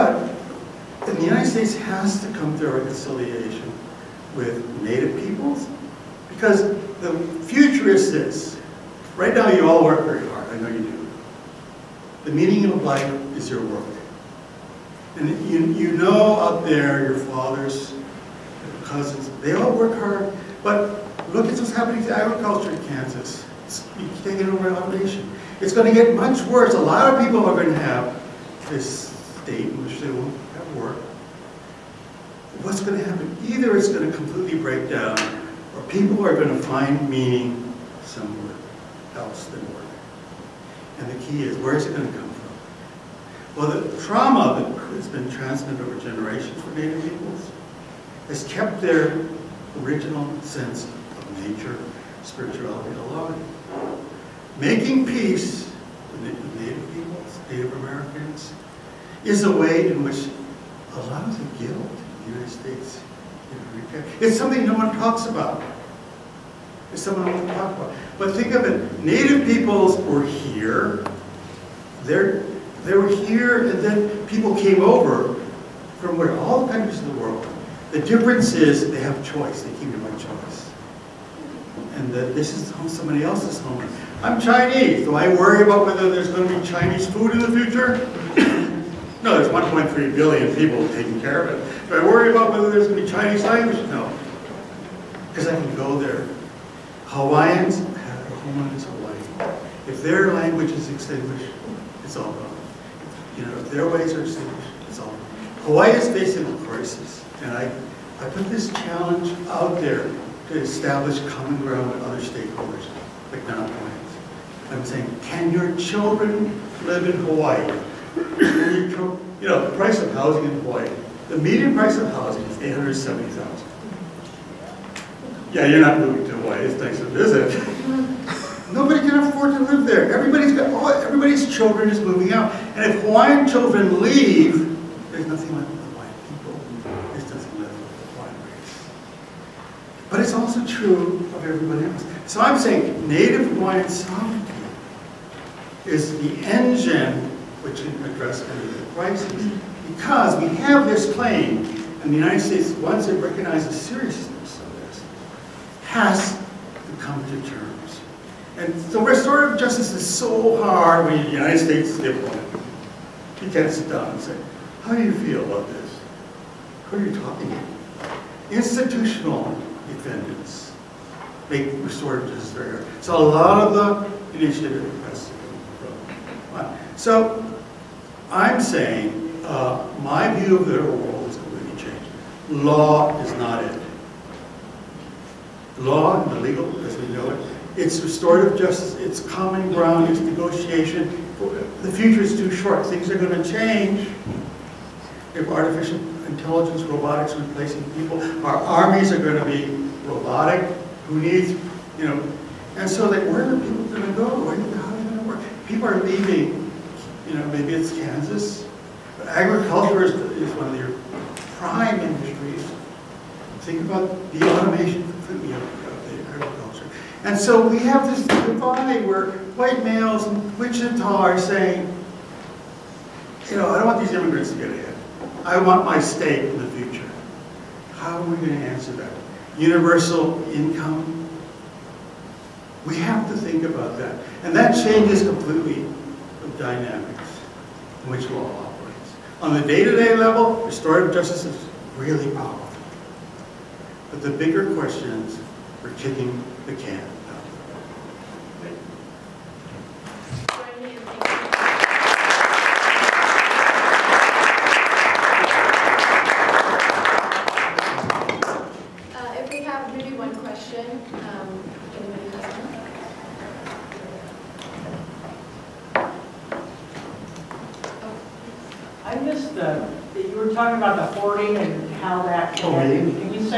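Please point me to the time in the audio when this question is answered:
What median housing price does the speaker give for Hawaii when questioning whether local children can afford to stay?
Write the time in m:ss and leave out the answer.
2:02.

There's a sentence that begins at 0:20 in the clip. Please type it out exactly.
But look at what's happening to agriculture in Kansas.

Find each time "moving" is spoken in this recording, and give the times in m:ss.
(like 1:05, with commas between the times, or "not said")
2:05, 2:11.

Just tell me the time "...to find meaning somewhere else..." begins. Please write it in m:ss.
0:36.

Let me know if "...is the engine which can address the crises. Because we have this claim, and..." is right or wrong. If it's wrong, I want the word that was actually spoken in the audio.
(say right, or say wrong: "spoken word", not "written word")
right.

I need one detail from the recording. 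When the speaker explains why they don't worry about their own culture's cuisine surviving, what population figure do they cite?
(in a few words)
1.3 billion.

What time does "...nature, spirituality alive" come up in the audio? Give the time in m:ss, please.
0:51.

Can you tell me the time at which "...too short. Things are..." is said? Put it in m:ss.
3:12.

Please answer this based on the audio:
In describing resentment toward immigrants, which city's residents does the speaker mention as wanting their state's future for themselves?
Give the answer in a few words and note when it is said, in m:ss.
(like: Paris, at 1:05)
Wichita, at 3:40.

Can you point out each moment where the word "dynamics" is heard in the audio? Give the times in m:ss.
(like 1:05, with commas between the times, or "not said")
3:56.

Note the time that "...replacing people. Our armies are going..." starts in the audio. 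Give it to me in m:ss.
3:17.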